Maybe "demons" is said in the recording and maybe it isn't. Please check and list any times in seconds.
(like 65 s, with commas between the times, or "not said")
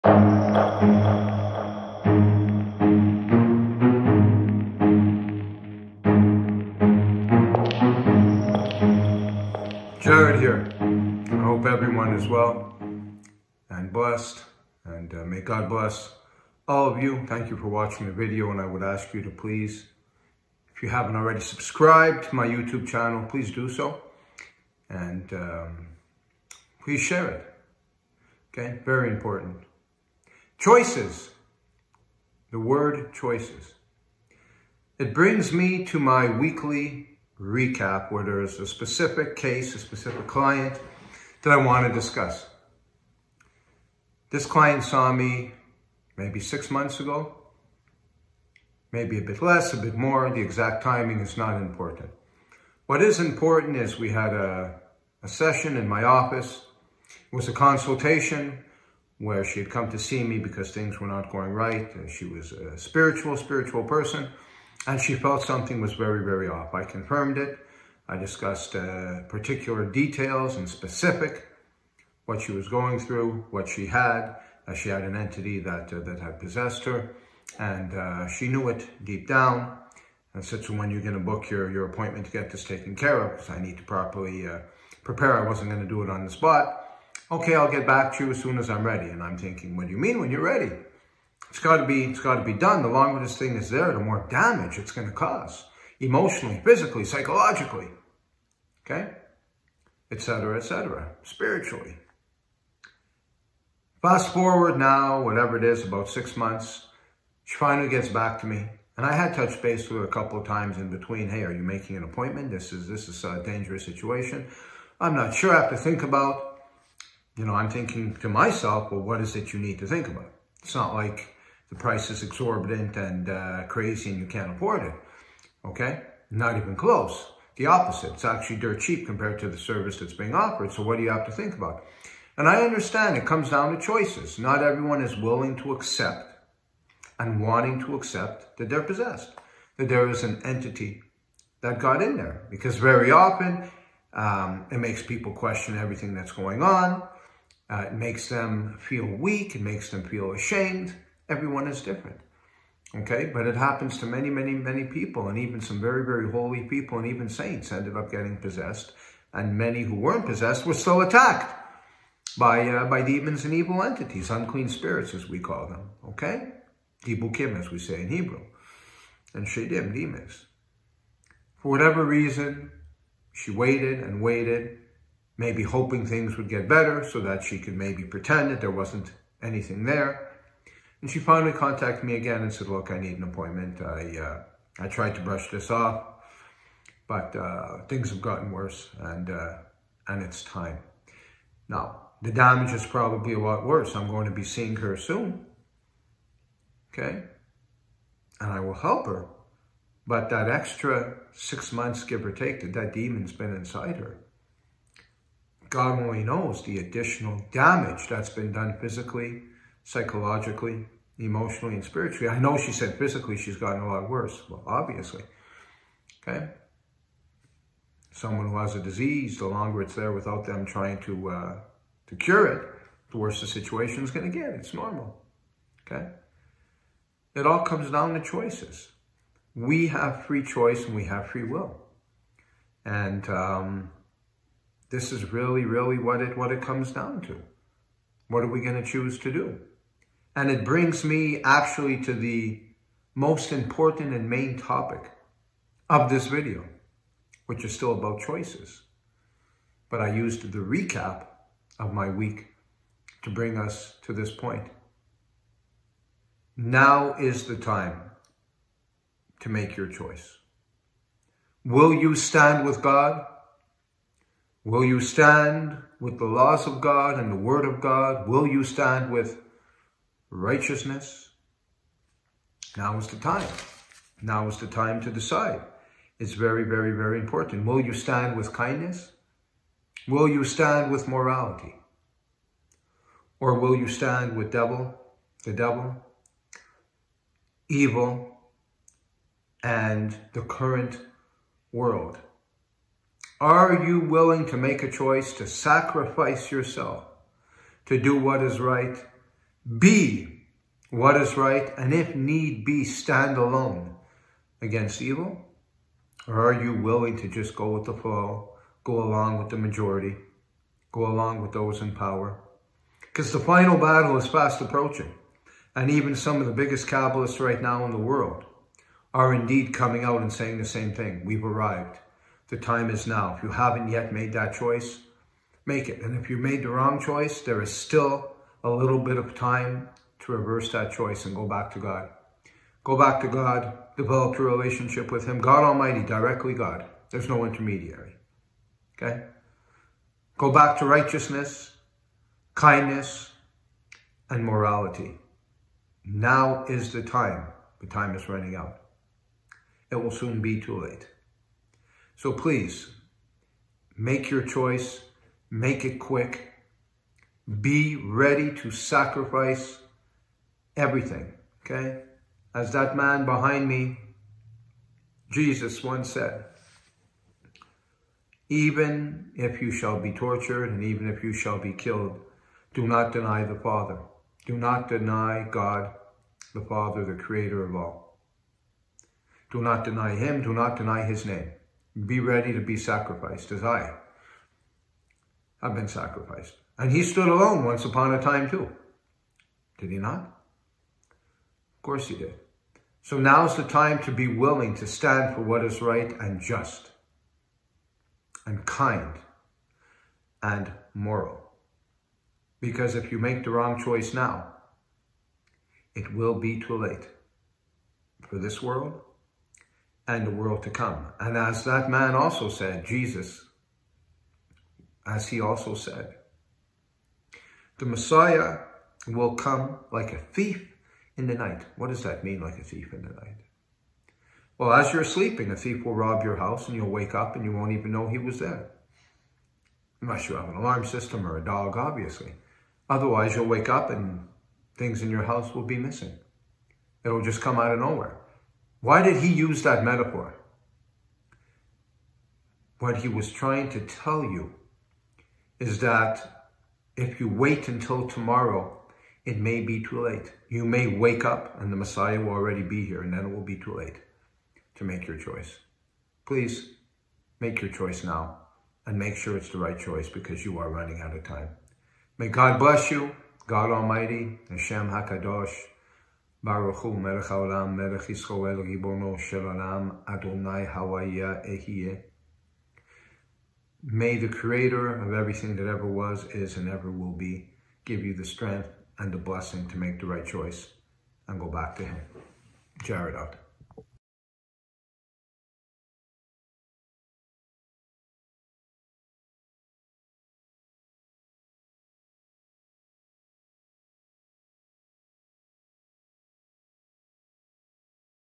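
163 s, 169 s, 202 s.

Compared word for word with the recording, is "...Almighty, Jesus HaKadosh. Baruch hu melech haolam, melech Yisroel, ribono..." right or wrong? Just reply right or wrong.
wrong.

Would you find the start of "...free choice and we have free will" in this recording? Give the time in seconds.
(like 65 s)
230 s.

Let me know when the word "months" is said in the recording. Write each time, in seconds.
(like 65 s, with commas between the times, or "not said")
46 s, 106 s, 201 s.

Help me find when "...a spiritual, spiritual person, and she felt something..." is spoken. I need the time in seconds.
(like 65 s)
62 s.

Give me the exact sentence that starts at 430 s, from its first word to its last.
Unless you have an alarm system or a dog, obviously.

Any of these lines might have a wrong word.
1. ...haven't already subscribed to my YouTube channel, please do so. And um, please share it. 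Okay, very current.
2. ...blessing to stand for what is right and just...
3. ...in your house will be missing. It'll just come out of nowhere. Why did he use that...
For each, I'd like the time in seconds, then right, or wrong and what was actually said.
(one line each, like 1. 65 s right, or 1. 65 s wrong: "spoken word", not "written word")
1. 20 s wrong: "important", not "current"
2. 394 s wrong: "willing", not "blessing"
3. 435 s right.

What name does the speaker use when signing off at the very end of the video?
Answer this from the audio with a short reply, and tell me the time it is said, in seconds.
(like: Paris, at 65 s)
Jarred, at 482 s.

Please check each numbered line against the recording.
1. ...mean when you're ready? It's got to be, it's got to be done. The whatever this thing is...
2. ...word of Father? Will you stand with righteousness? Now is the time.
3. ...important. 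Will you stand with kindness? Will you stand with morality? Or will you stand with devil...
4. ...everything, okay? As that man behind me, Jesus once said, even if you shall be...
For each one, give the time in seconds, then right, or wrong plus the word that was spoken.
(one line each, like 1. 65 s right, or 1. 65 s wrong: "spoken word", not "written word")
1. 89 s wrong: "longer", not "whatever"
2. 267 s wrong: "God", not "Father"
3. 277 s right
4. 360 s right.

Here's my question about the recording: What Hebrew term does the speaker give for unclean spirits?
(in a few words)
ibukim.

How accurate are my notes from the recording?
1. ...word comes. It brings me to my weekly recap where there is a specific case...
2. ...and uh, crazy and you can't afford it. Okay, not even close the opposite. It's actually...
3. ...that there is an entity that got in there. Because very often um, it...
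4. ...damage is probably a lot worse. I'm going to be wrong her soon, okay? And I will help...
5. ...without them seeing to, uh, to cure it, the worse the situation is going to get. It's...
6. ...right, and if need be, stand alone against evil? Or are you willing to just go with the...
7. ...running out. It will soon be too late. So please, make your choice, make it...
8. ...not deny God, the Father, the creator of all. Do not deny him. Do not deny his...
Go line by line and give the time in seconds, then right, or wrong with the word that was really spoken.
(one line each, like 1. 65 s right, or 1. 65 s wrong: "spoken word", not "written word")
1. 32 s wrong: "choices", not "comes"
2. 122 s right
3. 139 s right
4. 192 s wrong: "seeing", not "wrong"
5. 220 s wrong: "trying", not "seeing"
6. 301 s right
7. 348 s right
8. 374 s right.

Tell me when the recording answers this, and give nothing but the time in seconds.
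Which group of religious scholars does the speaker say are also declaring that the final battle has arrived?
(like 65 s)
316 s.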